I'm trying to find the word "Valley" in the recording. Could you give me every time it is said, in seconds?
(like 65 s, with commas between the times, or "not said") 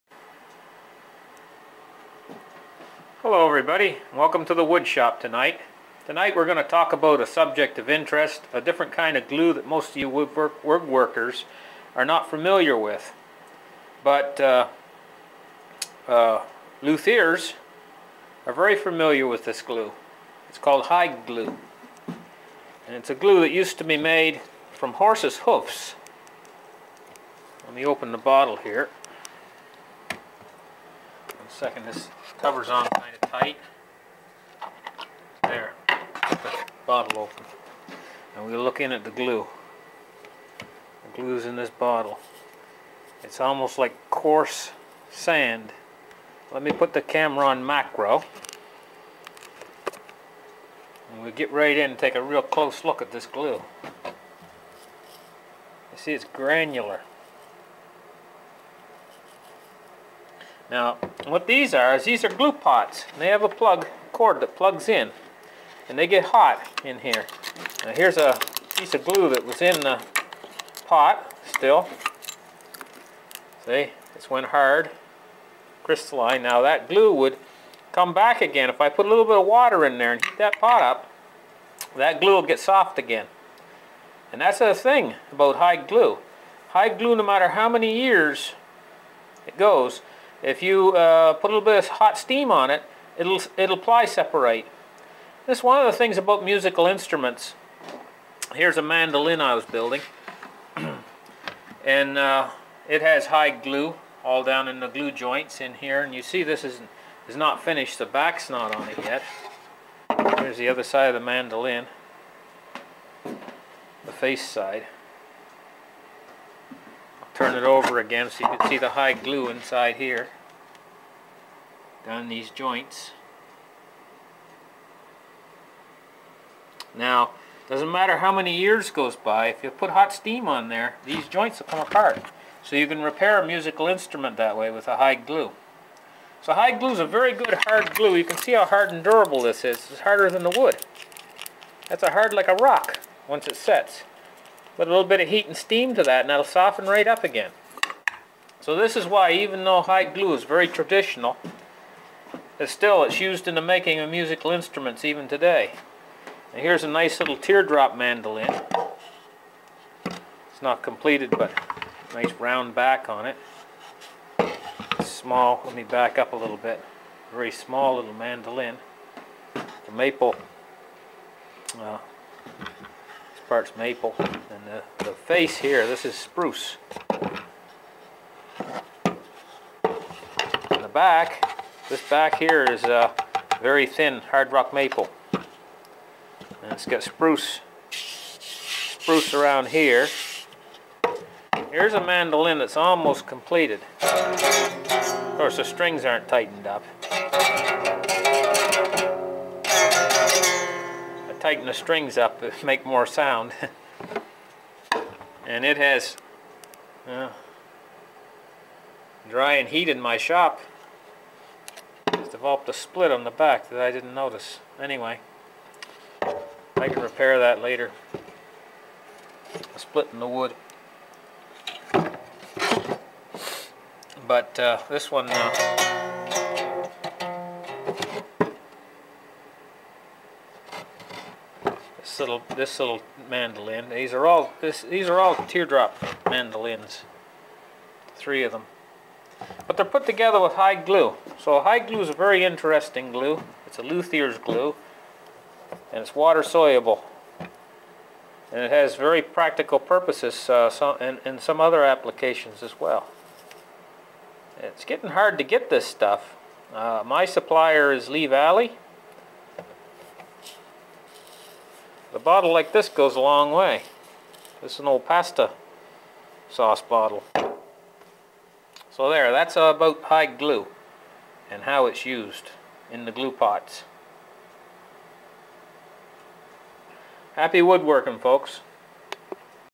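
258 s.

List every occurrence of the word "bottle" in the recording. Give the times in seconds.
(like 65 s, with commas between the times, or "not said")
28 s, 36 s, 41 s, 262 s, 266 s.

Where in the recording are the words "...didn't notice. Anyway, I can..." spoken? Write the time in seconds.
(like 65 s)
213 s.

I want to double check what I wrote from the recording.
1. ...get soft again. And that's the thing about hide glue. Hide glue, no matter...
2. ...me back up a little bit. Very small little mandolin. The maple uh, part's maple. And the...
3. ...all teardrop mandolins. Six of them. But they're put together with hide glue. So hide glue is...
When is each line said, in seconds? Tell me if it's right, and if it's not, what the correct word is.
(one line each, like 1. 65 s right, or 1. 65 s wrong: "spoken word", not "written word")
1. 82 s right
2. 165 s right
3. 235 s wrong: "Three", not "Six".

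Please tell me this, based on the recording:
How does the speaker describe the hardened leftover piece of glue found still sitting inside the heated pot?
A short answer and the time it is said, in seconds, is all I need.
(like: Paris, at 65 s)
Crystalline, at 75 s.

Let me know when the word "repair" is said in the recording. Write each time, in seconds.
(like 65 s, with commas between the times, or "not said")
133 s, 217 s.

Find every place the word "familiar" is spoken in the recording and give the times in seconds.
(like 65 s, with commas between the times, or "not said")
12 s, 18 s.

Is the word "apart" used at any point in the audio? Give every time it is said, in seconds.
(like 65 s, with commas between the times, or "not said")
131 s.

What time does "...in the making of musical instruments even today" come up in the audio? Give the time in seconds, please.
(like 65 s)
153 s.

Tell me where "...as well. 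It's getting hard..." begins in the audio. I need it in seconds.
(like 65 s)
252 s.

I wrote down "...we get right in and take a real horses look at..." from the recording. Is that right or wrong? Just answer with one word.
wrong.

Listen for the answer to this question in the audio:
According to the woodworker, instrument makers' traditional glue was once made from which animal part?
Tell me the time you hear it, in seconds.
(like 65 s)
24 s.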